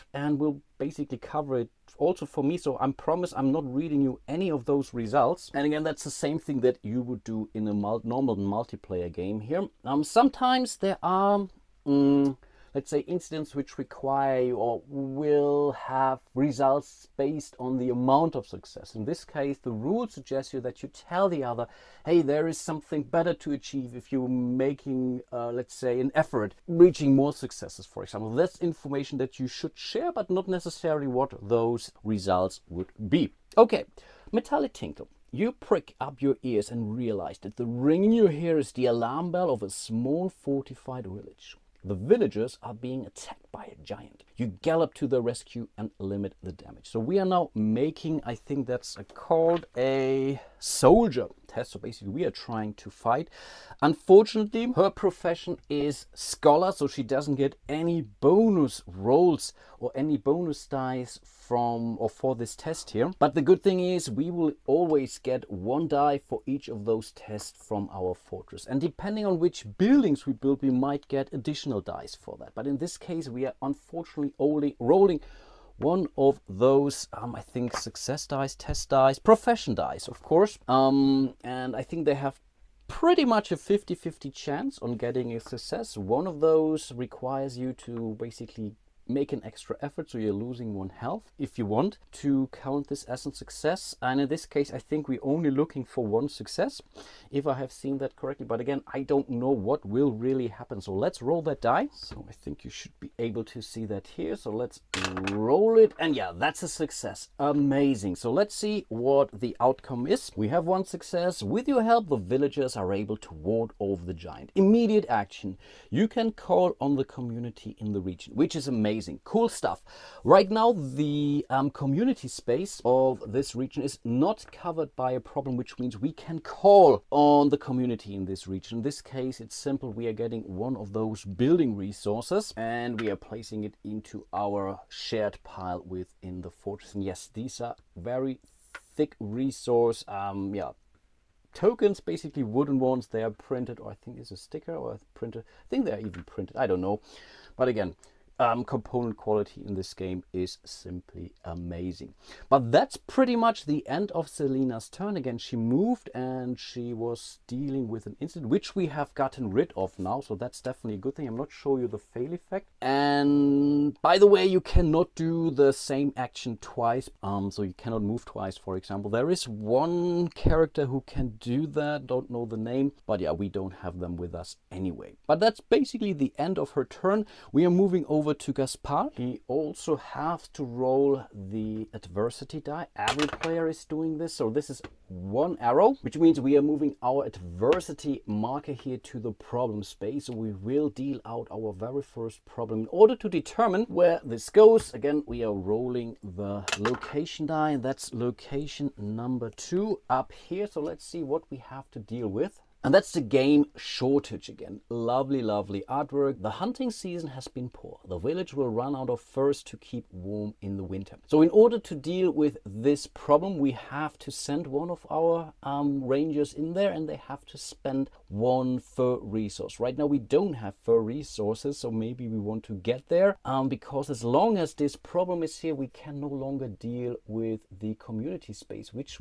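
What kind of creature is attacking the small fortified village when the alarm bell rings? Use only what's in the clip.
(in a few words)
A giant.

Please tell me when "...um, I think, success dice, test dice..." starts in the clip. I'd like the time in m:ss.
1:17.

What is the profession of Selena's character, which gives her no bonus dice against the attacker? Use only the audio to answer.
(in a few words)
Scholar.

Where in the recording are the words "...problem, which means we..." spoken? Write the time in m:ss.
2:05.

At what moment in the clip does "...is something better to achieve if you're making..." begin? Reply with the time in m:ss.
0:22.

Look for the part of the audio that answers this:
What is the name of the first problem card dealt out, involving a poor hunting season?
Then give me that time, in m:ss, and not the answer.
3:23.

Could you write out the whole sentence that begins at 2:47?
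Um, so you cannot move twice, for example.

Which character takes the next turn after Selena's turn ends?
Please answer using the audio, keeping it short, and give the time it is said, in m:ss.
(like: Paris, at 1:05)
Gaspard, at 2:58.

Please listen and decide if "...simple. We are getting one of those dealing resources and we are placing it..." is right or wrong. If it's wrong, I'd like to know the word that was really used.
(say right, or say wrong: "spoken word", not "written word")
wrong: "building", not "dealing".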